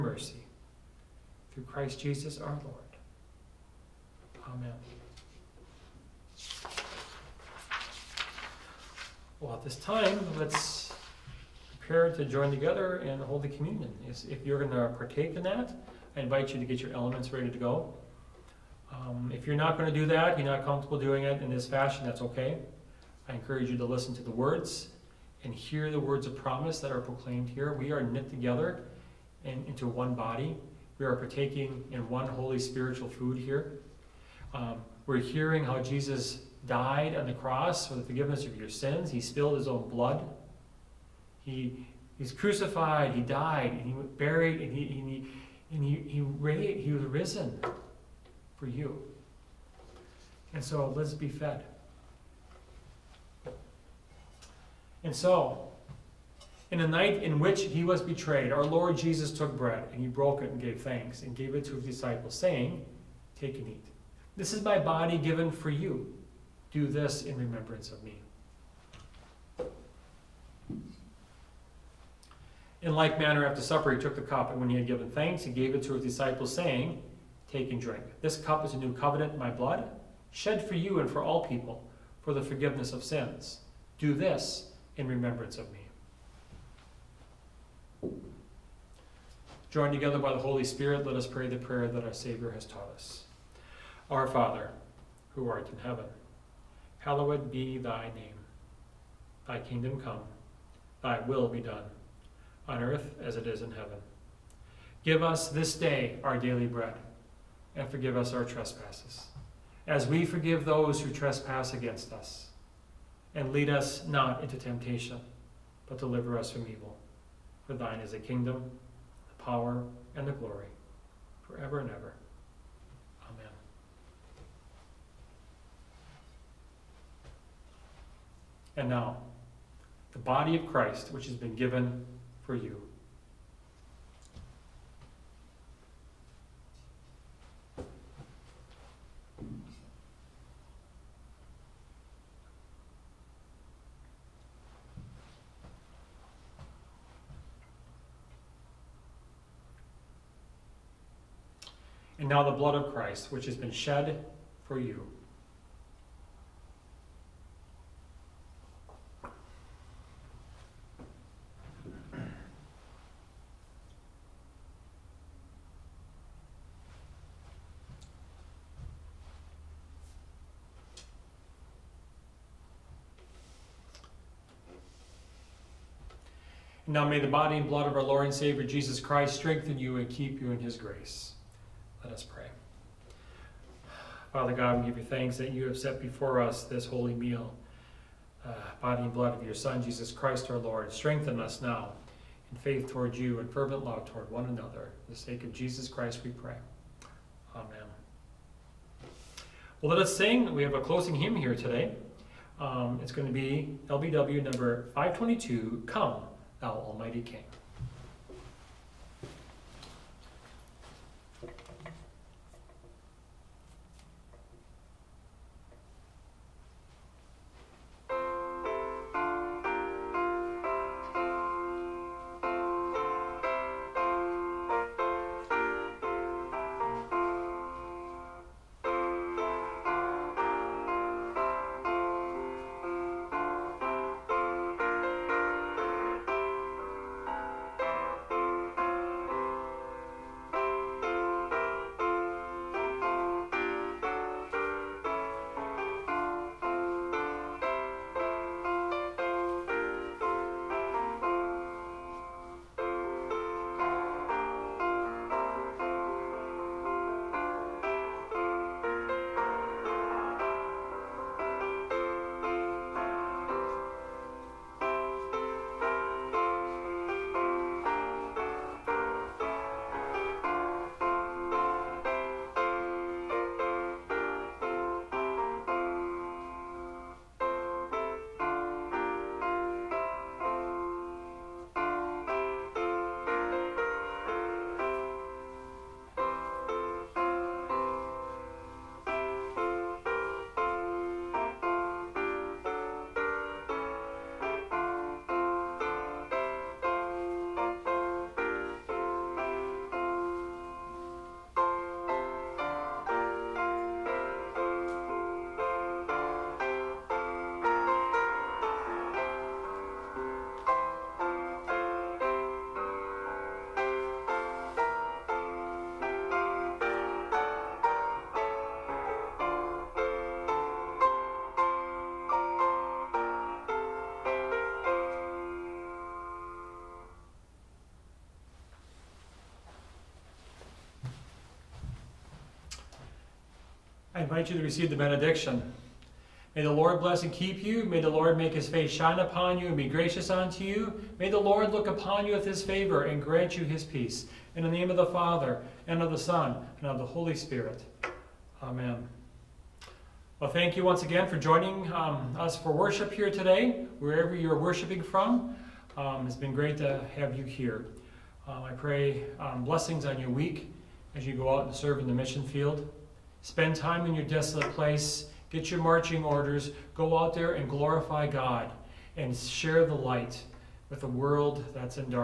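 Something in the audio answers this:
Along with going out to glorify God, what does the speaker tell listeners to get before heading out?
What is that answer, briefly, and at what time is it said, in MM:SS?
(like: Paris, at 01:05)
marching orders, at 06:05.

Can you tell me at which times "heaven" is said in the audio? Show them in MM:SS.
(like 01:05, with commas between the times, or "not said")
01:35, 01:43.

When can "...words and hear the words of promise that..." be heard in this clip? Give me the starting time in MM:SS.
00:24.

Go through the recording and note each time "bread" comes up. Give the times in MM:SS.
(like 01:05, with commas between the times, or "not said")
00:59, 01:46.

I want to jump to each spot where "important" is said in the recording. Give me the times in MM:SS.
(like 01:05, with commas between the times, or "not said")
not said.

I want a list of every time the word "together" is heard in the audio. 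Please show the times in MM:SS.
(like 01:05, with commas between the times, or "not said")
00:12, 00:28, 01:29.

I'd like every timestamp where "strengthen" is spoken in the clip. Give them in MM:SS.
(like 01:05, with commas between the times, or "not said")
02:59, 03:10.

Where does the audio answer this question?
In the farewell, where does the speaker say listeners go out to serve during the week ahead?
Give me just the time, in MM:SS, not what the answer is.
06:02.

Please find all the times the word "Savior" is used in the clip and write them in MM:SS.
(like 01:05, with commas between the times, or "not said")
01:32, 02:58.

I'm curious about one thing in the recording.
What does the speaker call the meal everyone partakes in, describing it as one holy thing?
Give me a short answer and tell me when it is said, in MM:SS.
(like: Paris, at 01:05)
spiritual food, at 00:32.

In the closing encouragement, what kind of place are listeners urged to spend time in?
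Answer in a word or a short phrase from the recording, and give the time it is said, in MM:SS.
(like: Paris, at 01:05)
desolate place, at 06:04.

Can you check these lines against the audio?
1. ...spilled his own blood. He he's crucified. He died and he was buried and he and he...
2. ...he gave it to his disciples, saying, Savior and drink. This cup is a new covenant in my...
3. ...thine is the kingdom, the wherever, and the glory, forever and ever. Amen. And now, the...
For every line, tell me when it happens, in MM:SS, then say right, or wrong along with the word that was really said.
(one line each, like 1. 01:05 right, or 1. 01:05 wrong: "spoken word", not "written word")
1. 00:39 right
2. 01:15 wrong: "Take", not "Savior"
3. 01:57 wrong: "power", not "wherever".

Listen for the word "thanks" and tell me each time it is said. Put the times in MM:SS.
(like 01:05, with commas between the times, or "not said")
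01:00, 01:15, 03:05, 05:50.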